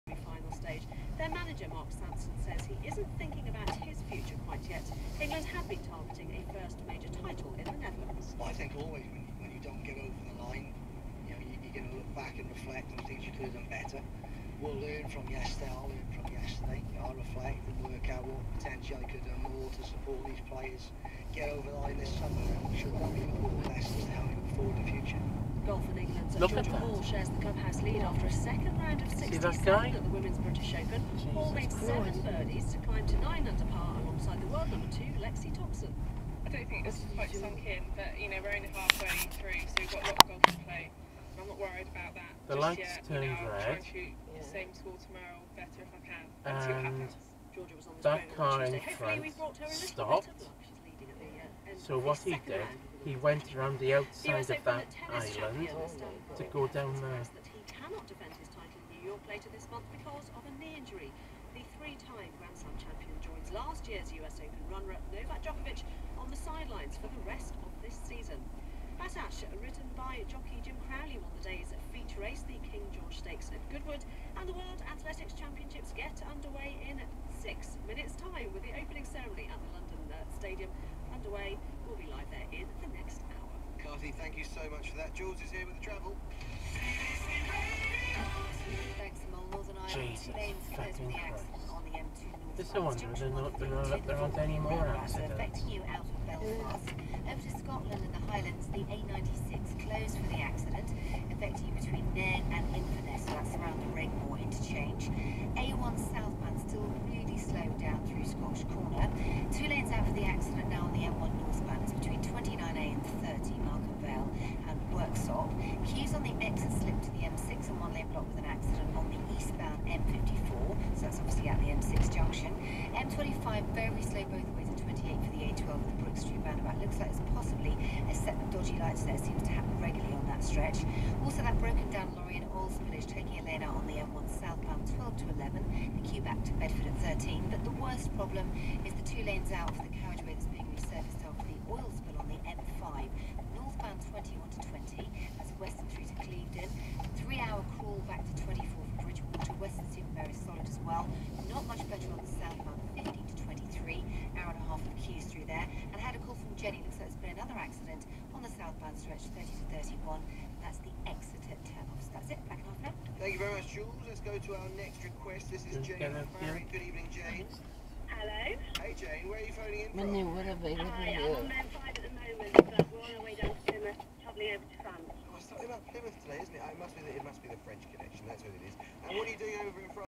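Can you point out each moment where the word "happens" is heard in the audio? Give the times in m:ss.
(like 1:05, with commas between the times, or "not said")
0:46, 2:09.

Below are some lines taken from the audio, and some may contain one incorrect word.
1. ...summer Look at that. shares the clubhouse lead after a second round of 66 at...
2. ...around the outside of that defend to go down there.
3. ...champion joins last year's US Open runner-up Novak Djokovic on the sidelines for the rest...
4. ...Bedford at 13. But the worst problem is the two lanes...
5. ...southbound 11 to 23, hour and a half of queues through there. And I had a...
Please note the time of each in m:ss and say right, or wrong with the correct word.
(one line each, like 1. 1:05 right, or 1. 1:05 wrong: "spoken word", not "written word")
1. 0:22 wrong: "67", not "66"
2. 0:53 wrong: "island", not "defend"
3. 1:02 right
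4. 2:16 right
5. 2:32 wrong: "15", not "11".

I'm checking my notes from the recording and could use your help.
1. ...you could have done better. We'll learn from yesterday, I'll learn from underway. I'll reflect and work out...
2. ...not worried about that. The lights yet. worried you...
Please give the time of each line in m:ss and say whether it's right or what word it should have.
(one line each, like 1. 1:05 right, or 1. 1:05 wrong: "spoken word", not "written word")
1. 0:13 wrong: "yesterday", not "underway"
2. 0:41 wrong: "turned", not "worried".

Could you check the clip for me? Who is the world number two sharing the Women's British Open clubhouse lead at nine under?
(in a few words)
Lexi Thompson.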